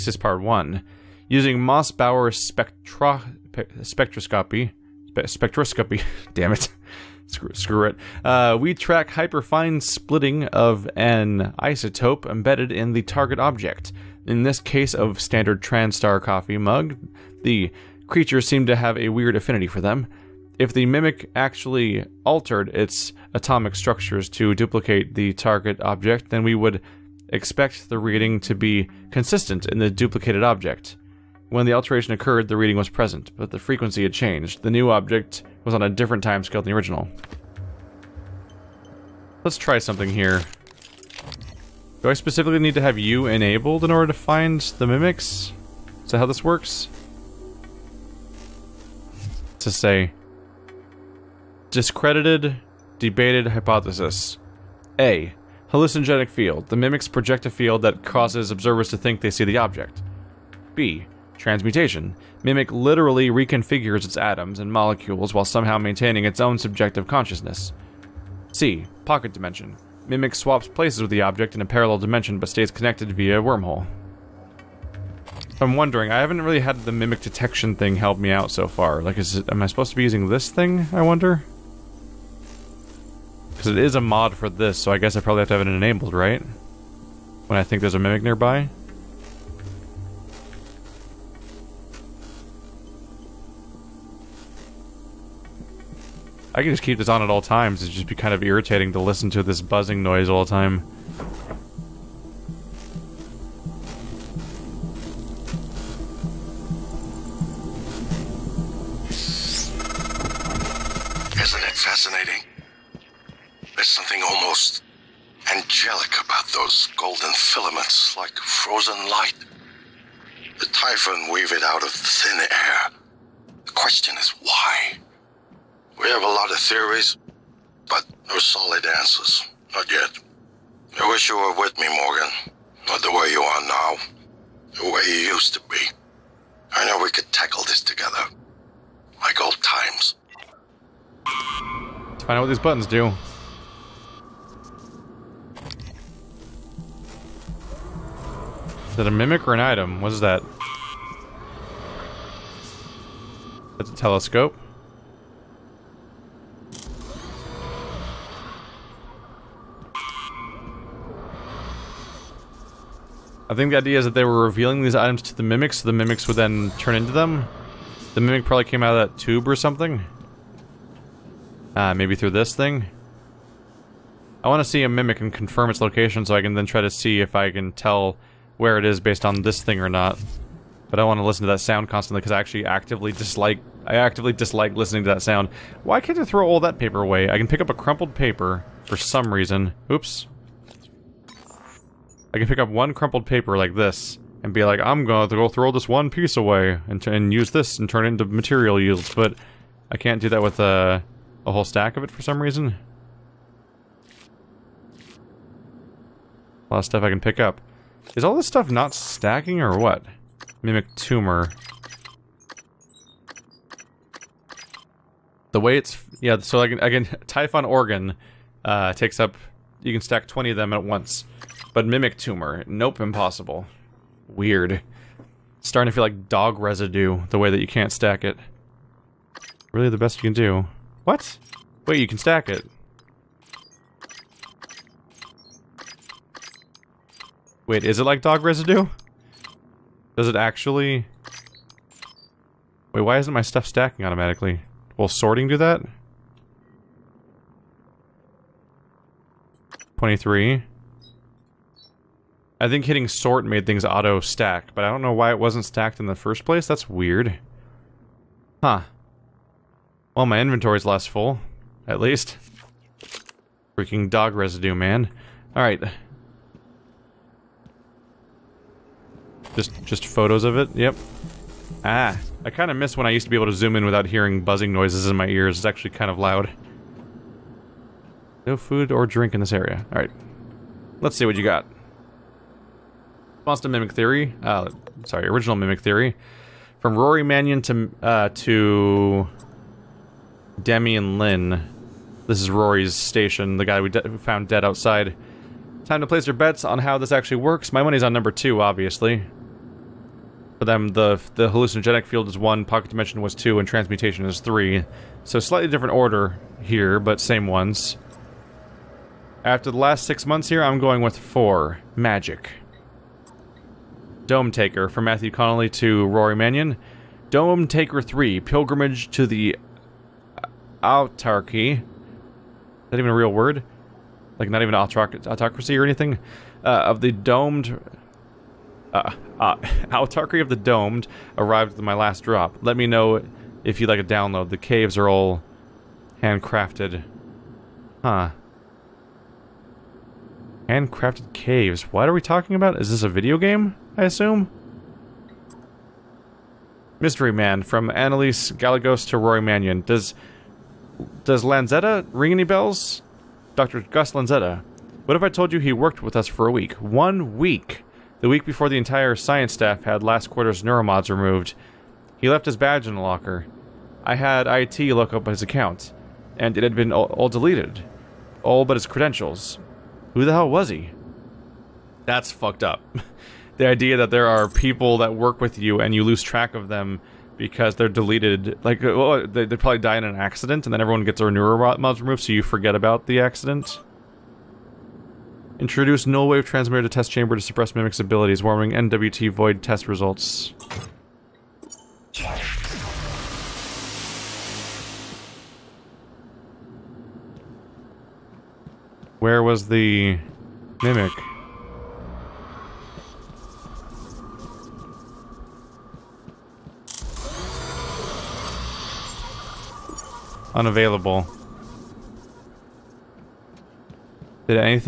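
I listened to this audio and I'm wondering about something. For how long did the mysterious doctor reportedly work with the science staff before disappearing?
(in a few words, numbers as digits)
One week.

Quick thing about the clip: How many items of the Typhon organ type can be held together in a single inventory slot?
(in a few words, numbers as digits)
20.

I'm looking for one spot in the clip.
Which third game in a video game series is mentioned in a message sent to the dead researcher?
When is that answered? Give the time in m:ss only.
5:17.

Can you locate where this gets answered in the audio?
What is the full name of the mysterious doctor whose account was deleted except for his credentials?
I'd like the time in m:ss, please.
5:53.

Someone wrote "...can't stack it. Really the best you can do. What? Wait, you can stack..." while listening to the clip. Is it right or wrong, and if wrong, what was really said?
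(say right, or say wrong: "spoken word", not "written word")
right.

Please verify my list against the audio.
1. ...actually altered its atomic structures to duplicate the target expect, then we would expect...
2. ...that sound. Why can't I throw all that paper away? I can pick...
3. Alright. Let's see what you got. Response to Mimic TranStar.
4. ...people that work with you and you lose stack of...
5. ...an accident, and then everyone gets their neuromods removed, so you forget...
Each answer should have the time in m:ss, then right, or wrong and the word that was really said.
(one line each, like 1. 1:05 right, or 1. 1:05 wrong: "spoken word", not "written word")
1. 0:21 wrong: "object", not "expect"
2. 3:05 right
3. 4:39 wrong: "Theory", not "TranStar"
4. 6:14 wrong: "track", not "stack"
5. 6:20 right.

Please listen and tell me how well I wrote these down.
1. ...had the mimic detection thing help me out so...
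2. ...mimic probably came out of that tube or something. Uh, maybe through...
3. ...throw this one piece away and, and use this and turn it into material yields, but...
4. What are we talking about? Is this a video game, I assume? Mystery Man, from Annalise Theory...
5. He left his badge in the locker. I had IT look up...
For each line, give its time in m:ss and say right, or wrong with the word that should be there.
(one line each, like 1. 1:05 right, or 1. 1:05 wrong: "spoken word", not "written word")
1. 1:16 right
2. 2:48 right
3. 3:15 right
4. 5:41 wrong: "Galagos", not "Theory"
5. 6:02 right.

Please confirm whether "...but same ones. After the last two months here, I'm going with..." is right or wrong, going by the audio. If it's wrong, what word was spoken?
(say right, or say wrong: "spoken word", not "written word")
wrong: "six", not "two".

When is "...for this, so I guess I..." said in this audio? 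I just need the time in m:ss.
1:24.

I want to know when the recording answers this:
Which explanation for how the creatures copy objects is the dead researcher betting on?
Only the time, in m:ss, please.
4:58.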